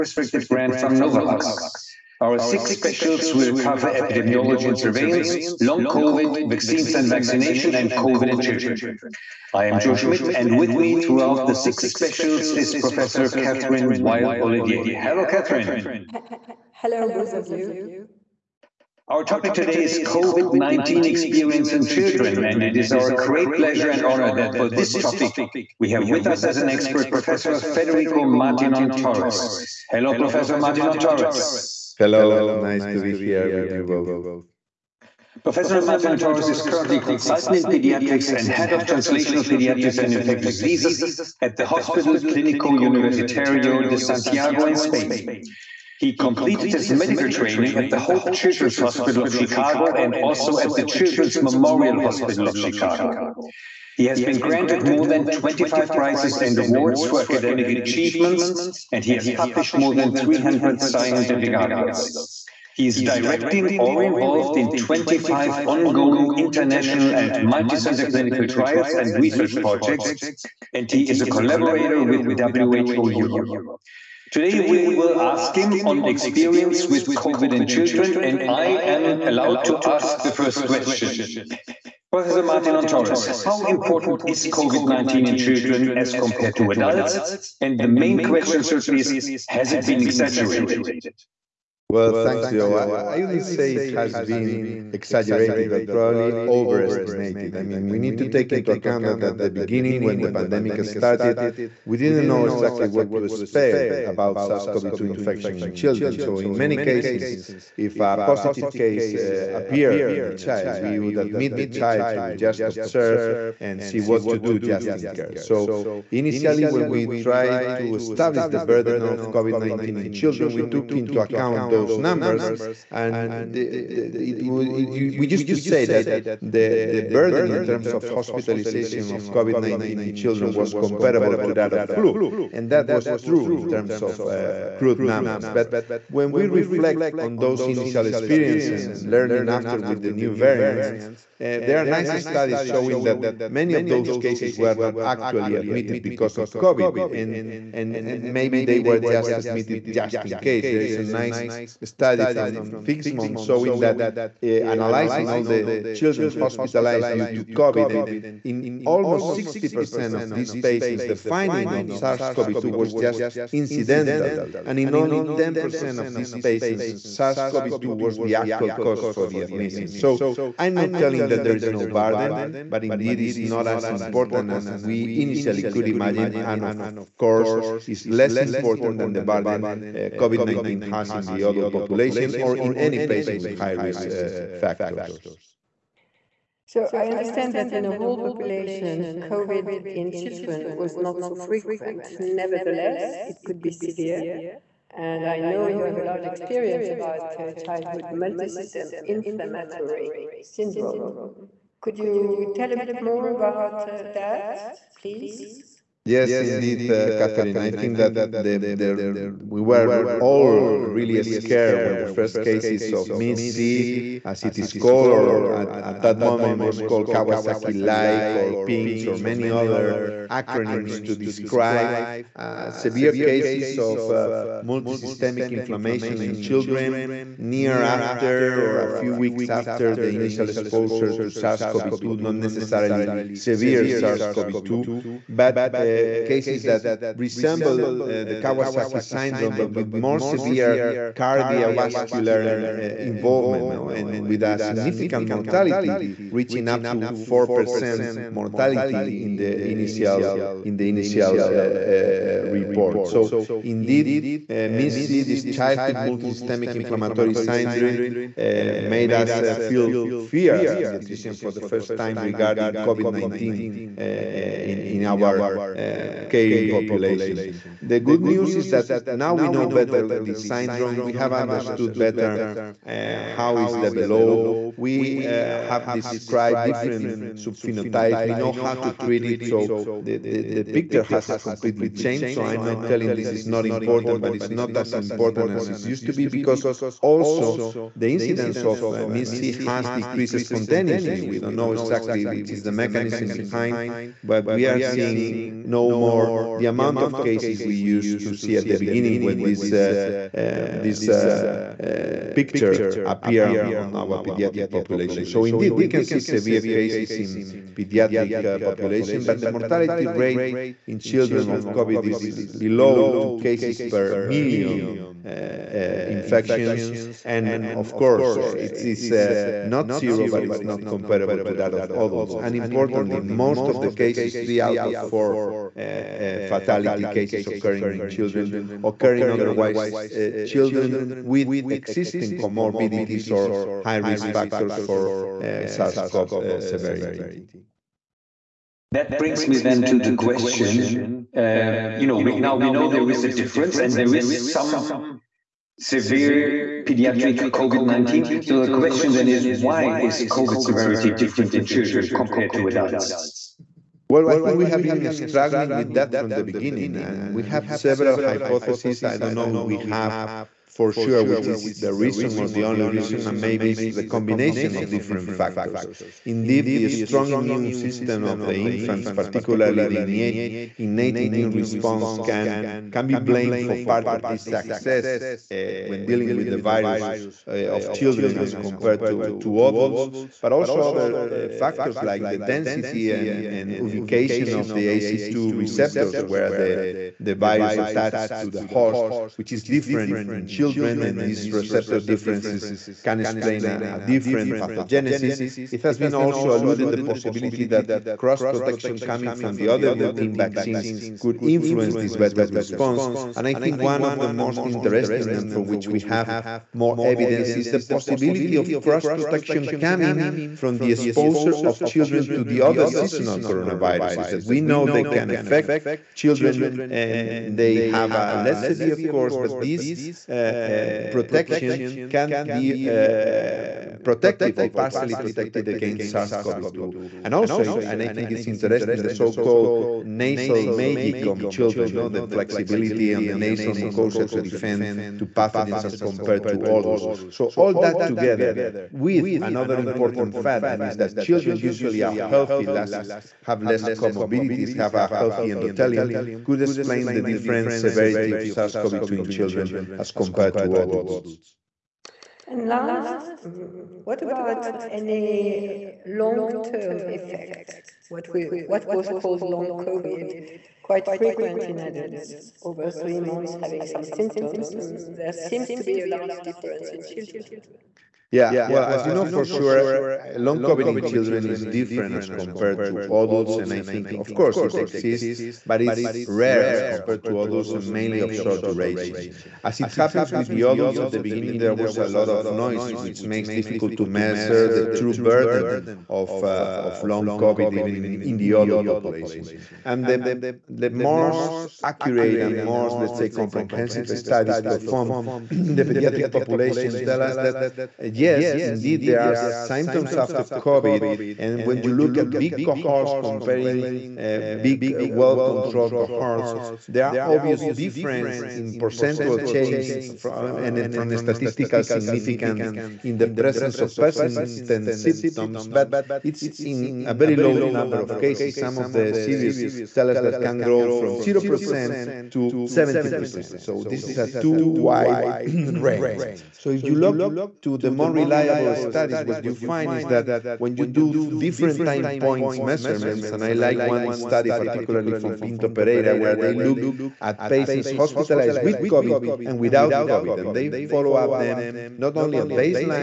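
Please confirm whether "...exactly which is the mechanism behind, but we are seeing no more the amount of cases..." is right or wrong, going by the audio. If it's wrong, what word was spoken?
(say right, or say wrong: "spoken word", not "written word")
right.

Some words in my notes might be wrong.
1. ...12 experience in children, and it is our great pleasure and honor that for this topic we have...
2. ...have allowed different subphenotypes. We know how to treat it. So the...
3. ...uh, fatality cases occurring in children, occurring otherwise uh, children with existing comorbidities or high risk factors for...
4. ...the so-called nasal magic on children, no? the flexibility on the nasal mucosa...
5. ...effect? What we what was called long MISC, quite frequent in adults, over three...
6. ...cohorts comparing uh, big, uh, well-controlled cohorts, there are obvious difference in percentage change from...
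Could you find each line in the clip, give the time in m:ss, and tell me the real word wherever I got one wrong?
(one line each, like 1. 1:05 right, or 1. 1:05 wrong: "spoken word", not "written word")
1. 0:20 wrong: "19", not "12"
2. 4:35 wrong: "described", not "allowed"
3. 5:26 right
4. 7:08 right
5. 7:37 wrong: "COVID", not "MISC"
6. 8:22 right.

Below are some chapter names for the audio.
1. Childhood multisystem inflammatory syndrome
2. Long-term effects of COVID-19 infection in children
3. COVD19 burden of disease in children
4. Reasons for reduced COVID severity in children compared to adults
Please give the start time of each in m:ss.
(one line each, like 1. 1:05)
1. 3:21
2. 7:36
3. 1:21
4. 5:51.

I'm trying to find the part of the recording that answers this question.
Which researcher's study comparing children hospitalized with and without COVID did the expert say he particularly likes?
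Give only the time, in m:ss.
8:55.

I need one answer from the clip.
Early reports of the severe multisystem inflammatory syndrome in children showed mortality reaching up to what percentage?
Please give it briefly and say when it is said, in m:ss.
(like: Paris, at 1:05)
4%, at 4:07.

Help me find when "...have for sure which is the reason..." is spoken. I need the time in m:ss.
5:59.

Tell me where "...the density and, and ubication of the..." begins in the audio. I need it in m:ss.
6:22.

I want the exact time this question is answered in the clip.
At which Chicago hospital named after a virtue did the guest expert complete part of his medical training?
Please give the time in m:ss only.
0:47.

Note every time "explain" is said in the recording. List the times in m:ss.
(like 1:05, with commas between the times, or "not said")
6:33, 7:26.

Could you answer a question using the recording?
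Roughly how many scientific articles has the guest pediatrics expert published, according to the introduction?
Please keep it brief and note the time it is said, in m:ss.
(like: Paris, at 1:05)
more than 300, at 0:59.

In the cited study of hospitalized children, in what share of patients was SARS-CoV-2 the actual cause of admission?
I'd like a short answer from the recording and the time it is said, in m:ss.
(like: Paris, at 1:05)
10%, at 2:45.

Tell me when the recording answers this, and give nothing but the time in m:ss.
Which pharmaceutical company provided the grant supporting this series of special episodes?
0:00.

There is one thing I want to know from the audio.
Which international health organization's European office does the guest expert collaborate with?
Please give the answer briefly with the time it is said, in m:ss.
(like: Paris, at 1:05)
WHO Europe, at 1:12.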